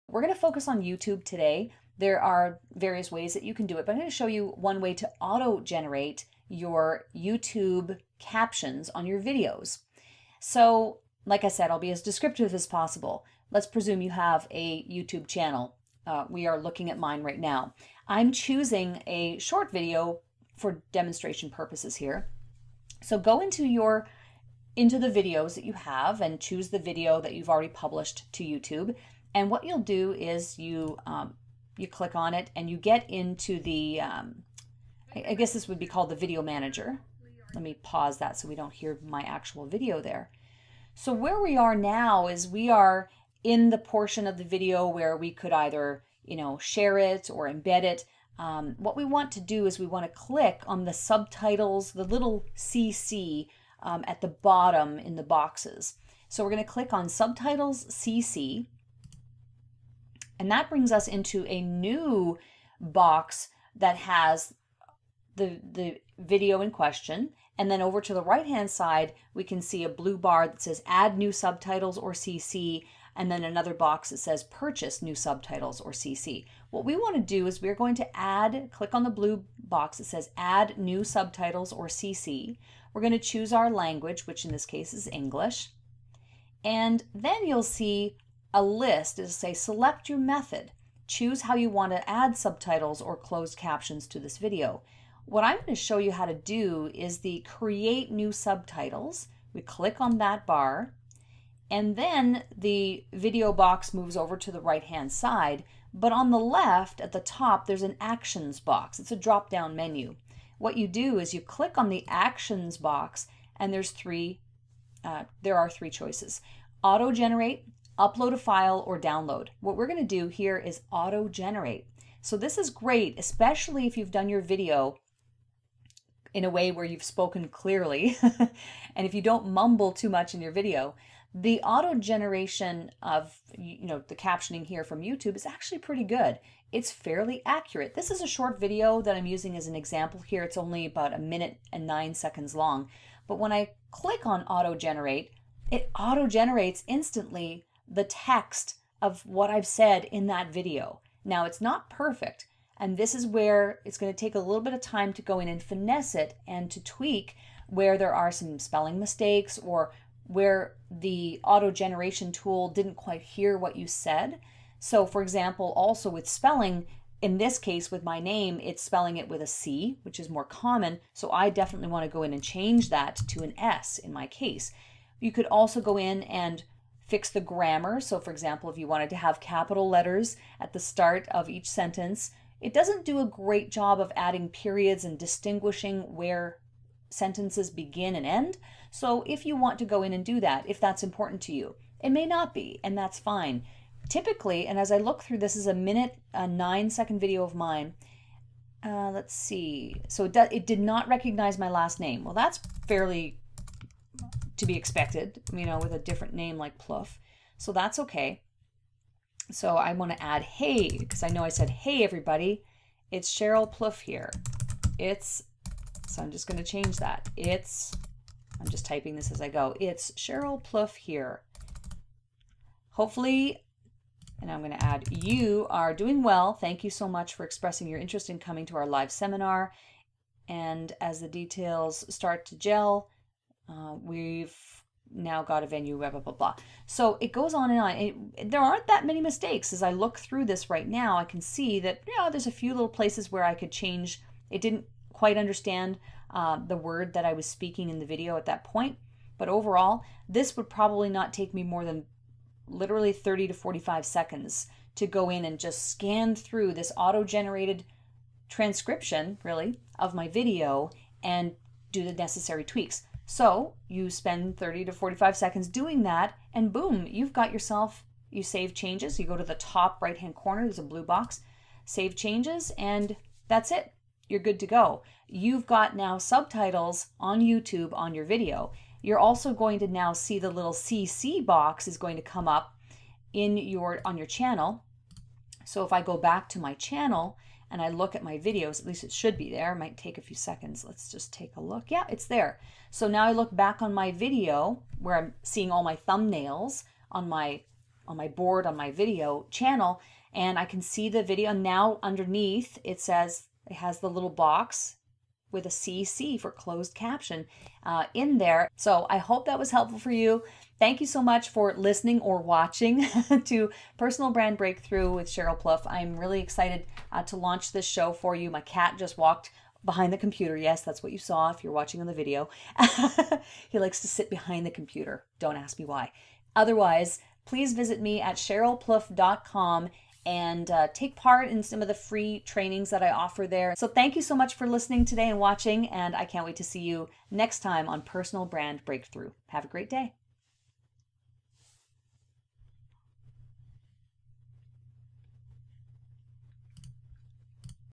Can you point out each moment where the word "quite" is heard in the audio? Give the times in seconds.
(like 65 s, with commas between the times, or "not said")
162 s, 245 s.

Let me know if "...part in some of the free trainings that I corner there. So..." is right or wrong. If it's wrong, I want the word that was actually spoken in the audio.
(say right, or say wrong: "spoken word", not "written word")
wrong: "offer", not "corner".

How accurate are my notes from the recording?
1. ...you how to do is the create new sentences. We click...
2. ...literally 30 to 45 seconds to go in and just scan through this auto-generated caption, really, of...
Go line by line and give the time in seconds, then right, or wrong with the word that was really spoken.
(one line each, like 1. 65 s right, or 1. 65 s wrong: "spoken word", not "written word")
1. 95 s wrong: "subtitles", not "sentences"
2. 252 s wrong: "transcription", not "caption".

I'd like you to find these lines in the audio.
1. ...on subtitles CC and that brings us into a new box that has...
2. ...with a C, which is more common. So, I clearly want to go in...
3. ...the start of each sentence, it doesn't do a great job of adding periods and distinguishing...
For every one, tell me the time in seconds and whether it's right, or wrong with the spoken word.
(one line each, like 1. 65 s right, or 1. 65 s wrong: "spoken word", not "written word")
1. 56 s right
2. 169 s wrong: "definitely", not "clearly"
3. 180 s right.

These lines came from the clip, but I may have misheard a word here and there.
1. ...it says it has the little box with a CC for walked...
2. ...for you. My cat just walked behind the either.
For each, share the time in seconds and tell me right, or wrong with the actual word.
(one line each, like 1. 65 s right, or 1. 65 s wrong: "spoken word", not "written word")
1. 302 s wrong: "closed", not "walked"
2. 318 s wrong: "computer", not "either".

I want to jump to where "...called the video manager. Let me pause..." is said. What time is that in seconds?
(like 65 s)
35 s.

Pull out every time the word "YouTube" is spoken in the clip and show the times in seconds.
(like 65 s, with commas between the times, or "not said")
0 s, 7 s, 14 s, 28 s, 135 s, 277 s.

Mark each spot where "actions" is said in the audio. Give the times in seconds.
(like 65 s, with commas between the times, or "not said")
108 s, 112 s.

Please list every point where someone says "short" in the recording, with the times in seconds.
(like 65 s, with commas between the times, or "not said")
19 s, 138 s.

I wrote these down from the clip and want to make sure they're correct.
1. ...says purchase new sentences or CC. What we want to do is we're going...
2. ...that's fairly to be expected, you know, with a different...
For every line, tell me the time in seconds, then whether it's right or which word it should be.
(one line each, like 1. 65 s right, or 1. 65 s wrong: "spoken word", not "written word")
1. 74 s wrong: "subtitles", not "sentences"
2. 202 s right.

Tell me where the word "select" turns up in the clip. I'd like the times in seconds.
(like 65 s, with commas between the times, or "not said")
89 s.